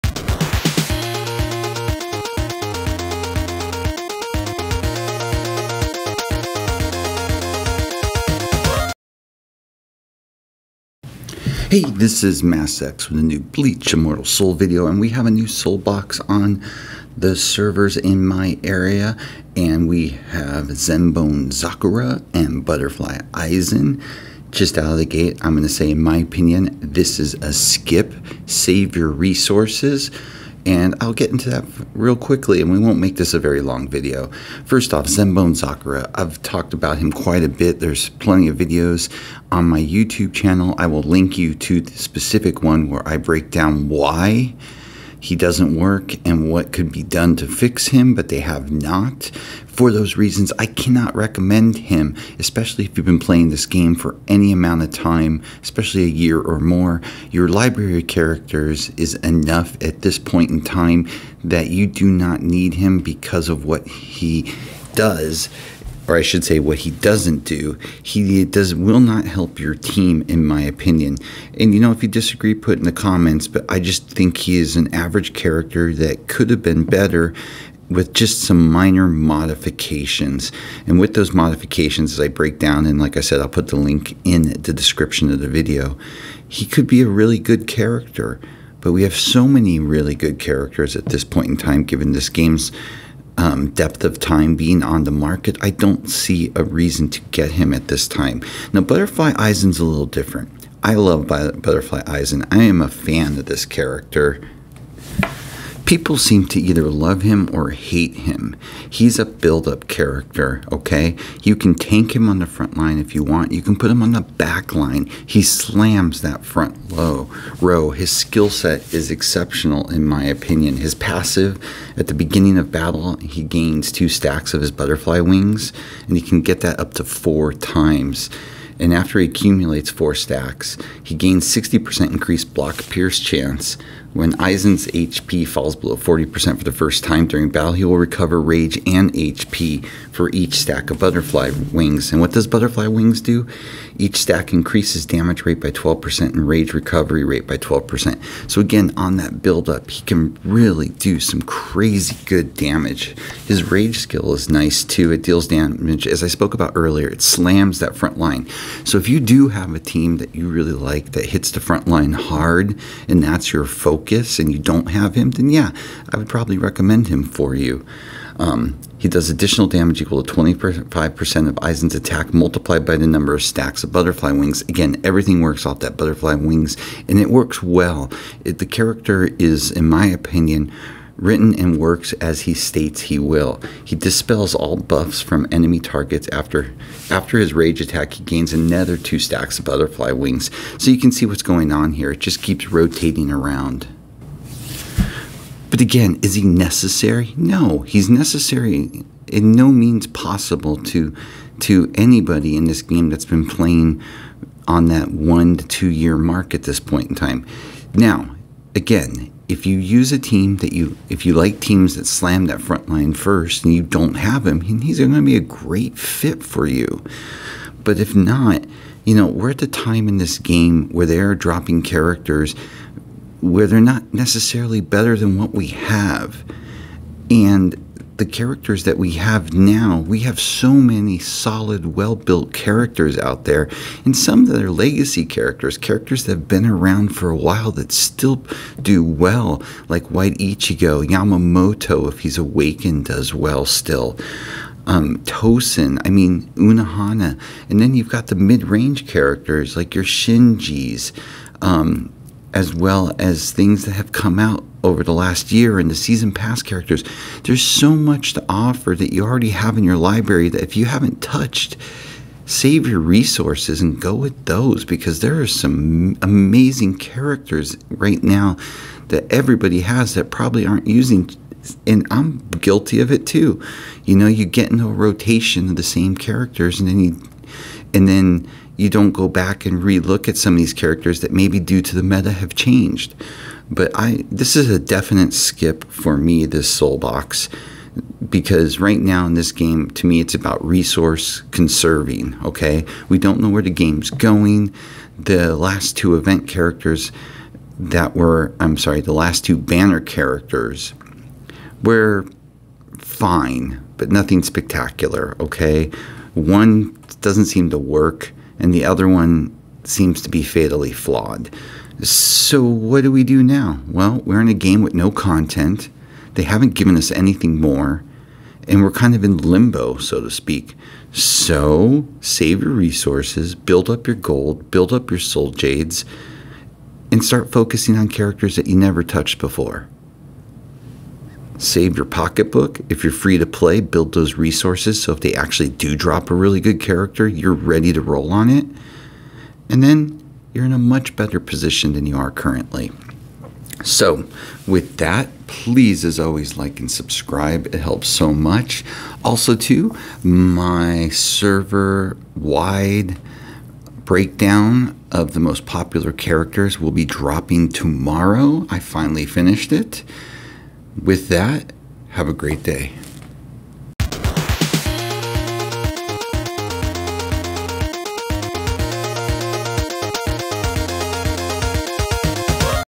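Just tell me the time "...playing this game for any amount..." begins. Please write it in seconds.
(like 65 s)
53 s.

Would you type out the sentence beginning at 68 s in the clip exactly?
He does will not help your team, in my opinion.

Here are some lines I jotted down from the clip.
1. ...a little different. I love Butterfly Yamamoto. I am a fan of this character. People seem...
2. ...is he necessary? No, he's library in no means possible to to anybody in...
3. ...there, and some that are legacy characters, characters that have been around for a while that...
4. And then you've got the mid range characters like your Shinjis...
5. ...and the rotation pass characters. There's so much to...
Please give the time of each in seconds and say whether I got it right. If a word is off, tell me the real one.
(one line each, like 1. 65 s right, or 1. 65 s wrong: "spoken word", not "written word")
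1. 99 s wrong: "Aizen", not "Yamamoto"
2. 196 s wrong: "necessary", not "library"
3. 233 s right
4. 247 s right
5. 255 s wrong: "season", not "rotation".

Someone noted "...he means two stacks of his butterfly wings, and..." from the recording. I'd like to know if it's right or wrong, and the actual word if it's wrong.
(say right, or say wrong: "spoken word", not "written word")
wrong: "gains", not "means".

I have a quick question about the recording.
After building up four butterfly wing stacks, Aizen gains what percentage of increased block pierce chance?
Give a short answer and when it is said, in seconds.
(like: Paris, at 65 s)
60%, at 131 s.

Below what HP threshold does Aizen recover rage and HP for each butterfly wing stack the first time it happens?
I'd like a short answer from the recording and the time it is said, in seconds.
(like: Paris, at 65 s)
40%, at 135 s.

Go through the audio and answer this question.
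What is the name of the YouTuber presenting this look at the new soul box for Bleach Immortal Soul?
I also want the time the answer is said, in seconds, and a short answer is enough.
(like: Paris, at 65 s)
MassX, at 12 s.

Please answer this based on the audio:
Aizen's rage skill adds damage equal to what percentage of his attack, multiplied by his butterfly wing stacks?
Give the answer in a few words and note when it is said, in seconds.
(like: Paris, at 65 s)
25%, at 170 s.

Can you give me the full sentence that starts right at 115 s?
He slams that front low row.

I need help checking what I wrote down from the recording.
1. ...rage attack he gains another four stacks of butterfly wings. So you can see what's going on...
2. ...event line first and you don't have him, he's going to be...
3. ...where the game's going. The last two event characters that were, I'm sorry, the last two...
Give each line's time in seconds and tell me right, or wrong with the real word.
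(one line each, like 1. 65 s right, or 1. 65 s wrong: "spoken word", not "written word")
1. 187 s wrong: "two", not "four"
2. 212 s wrong: "front", not "event"
3. 293 s right.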